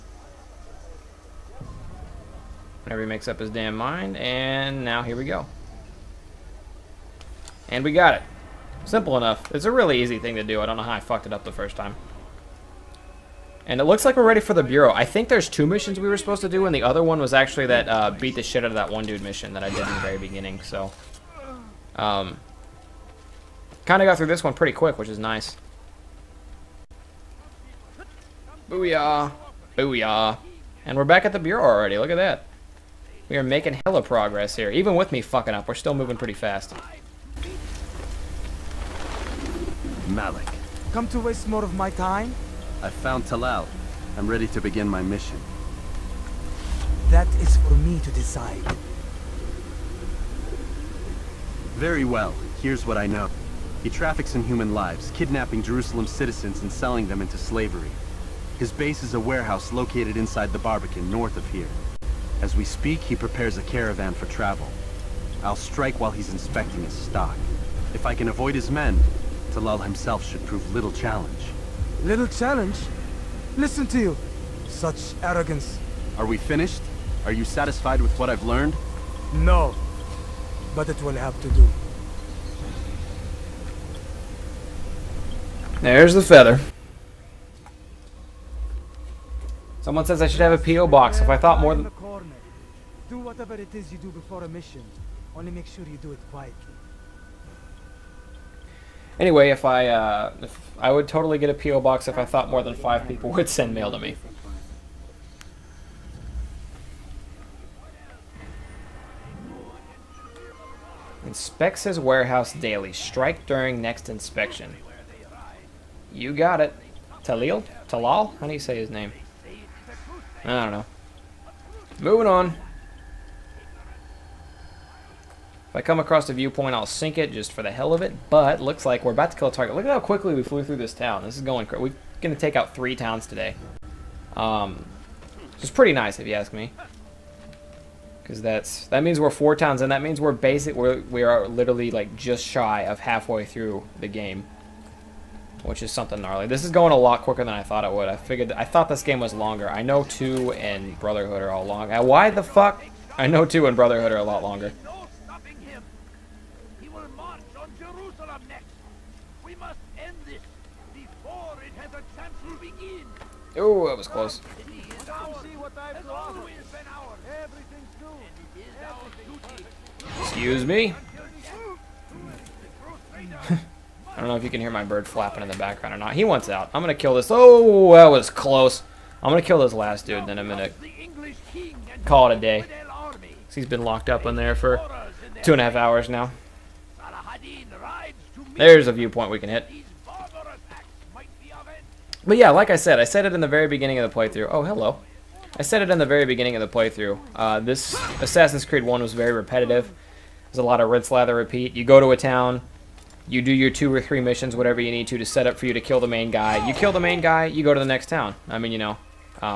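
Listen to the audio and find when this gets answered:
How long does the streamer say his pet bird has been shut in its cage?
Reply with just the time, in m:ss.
3:05.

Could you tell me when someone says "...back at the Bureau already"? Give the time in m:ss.
0:31.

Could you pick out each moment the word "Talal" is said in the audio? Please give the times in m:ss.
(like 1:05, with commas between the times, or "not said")
0:43, 1:09, 1:57.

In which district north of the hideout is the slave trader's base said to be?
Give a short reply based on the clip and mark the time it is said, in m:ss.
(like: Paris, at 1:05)
The Barbican, at 1:00.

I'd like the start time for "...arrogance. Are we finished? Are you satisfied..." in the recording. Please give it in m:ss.
1:15.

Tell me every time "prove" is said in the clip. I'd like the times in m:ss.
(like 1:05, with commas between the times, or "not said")
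1:10.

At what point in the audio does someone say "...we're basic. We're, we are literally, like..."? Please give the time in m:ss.
2:20.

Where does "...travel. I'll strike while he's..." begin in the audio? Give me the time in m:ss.
1:04.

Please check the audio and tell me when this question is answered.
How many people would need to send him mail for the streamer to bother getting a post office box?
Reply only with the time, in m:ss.
1:42.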